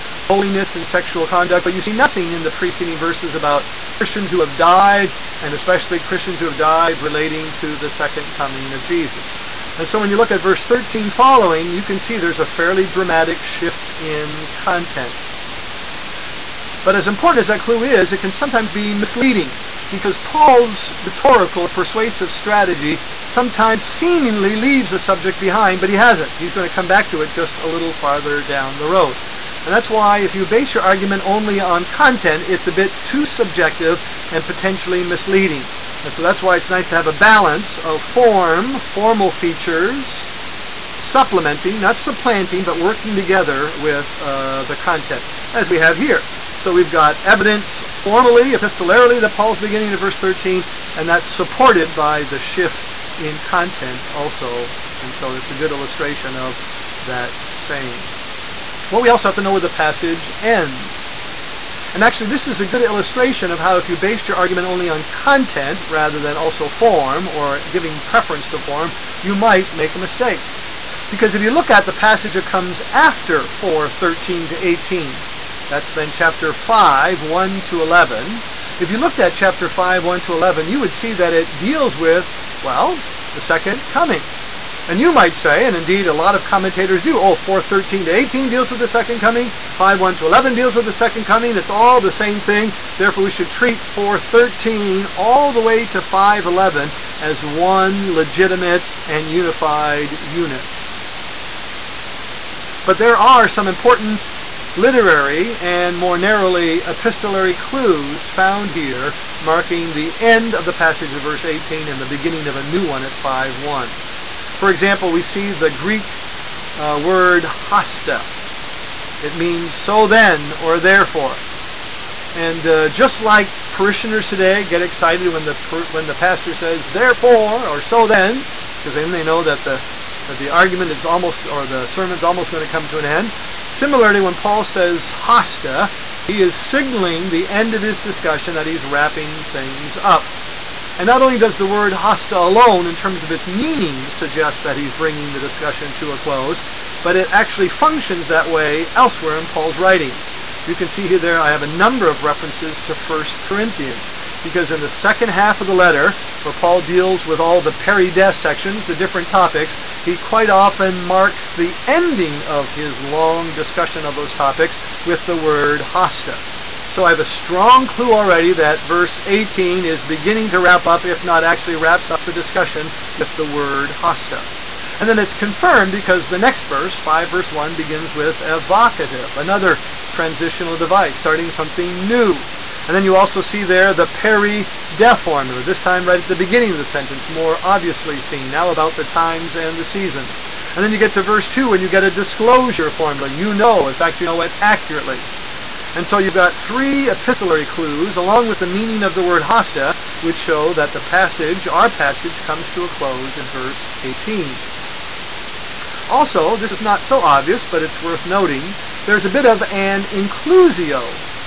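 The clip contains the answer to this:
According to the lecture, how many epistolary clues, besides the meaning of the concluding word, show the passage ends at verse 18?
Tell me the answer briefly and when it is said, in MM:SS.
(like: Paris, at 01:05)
3, at 03:16.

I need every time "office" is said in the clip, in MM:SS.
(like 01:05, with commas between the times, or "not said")
not said.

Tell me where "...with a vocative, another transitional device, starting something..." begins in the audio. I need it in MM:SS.
02:58.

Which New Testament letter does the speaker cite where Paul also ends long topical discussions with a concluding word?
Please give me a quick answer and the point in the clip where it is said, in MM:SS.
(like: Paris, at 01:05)
1 Corinthians, at 02:32.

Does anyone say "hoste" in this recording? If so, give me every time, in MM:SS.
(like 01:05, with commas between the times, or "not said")
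01:57, 02:15, 02:21, 02:45, 02:53, 03:19.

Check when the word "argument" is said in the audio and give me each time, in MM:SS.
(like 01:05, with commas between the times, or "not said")
00:30, 01:04, 02:10.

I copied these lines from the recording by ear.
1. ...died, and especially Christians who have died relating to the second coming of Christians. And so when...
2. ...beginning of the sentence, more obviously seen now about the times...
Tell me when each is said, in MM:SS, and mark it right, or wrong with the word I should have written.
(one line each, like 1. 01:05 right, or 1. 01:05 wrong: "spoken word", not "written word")
1. 00:04 wrong: "Jesus", not "Christians"
2. 03:06 right.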